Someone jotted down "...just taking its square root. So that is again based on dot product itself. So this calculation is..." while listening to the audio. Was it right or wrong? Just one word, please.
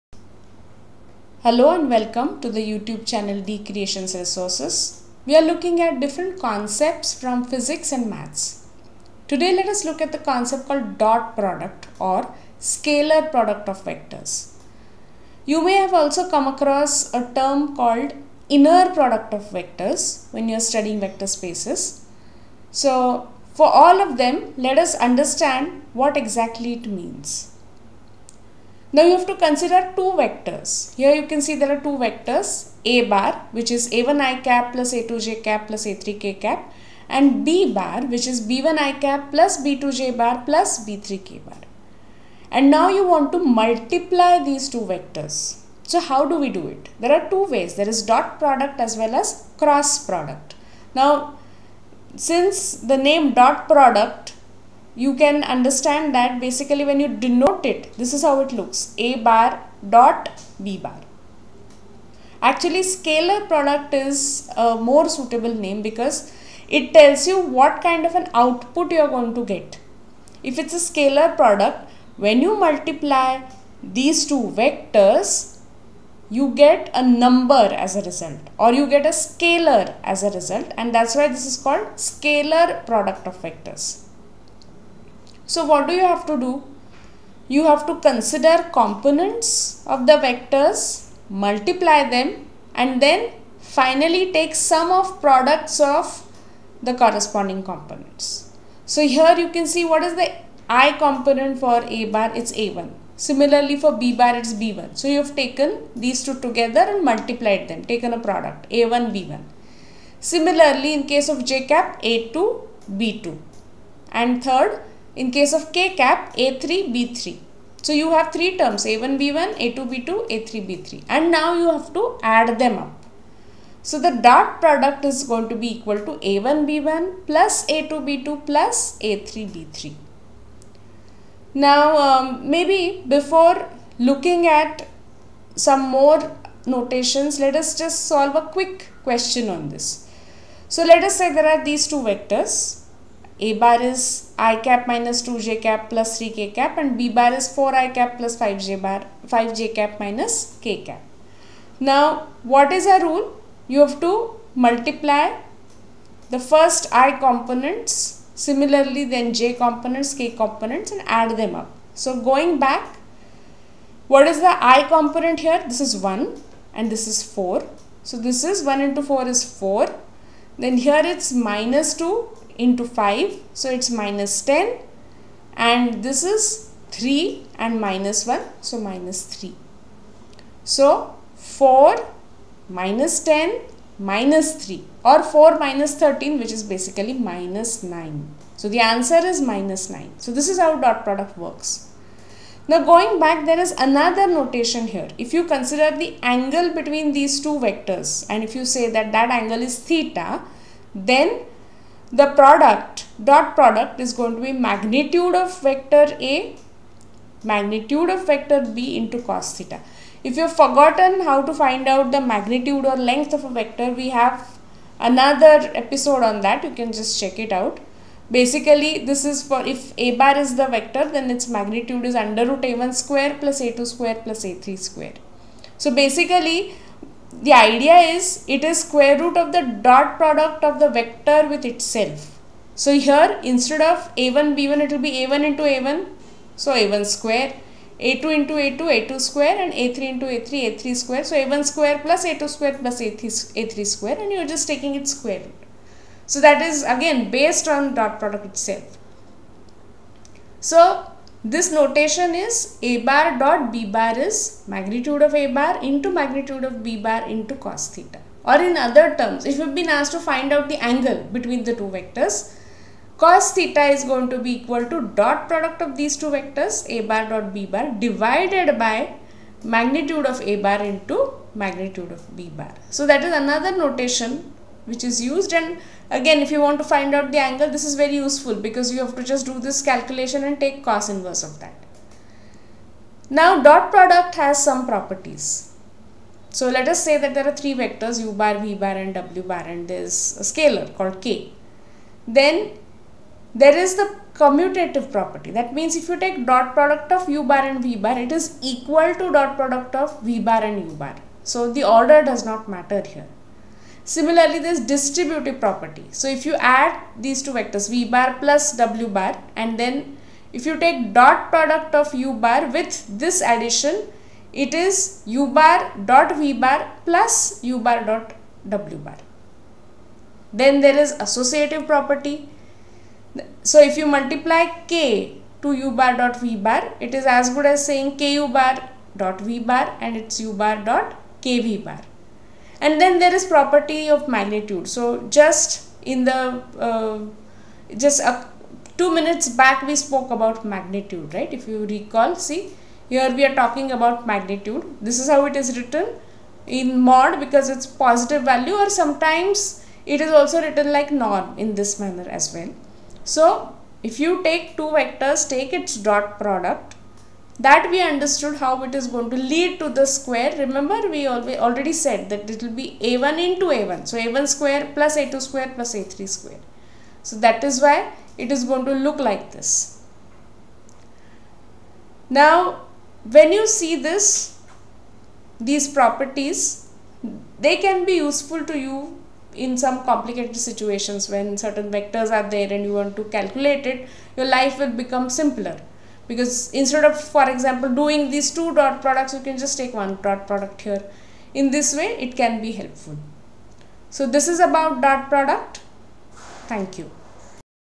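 wrong.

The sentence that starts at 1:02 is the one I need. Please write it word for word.
Actually, scalar product is a more suitable name because it tells you what kind of an output you are going to get.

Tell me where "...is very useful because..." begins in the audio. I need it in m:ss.
4:37.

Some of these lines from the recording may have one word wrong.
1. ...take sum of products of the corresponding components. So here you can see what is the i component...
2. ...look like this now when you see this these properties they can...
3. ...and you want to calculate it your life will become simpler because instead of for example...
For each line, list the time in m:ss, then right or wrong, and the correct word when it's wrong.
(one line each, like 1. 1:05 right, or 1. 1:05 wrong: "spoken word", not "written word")
1. 1:34 right
2. 6:09 right
3. 6:22 right.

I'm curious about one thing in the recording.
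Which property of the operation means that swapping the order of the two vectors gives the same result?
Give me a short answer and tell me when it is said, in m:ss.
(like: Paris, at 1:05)
commutative property, at 4:54.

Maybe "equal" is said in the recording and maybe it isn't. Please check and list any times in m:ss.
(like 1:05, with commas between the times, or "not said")
2:05, 4:24, 4:58.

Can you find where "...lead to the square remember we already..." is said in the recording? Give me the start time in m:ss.
5:59.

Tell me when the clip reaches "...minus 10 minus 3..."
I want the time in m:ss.
3:02.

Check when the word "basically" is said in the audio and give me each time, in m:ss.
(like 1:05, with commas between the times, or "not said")
0:56, 3:06, 3:38, 3:45.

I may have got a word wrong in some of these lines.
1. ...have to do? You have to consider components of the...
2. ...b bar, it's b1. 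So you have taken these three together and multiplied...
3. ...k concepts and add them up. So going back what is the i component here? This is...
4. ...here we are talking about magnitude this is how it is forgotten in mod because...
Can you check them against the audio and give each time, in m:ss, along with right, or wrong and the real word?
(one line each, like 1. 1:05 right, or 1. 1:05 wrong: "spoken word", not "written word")
1. 1:26 right
2. 1:43 wrong: "two", not "three"
3. 2:40 wrong: "components", not "concepts"
4. 5:43 wrong: "written", not "forgotten".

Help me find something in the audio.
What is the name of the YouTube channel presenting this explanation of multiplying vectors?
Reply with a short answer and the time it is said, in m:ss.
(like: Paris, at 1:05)
D Creations Resources, at 0:03.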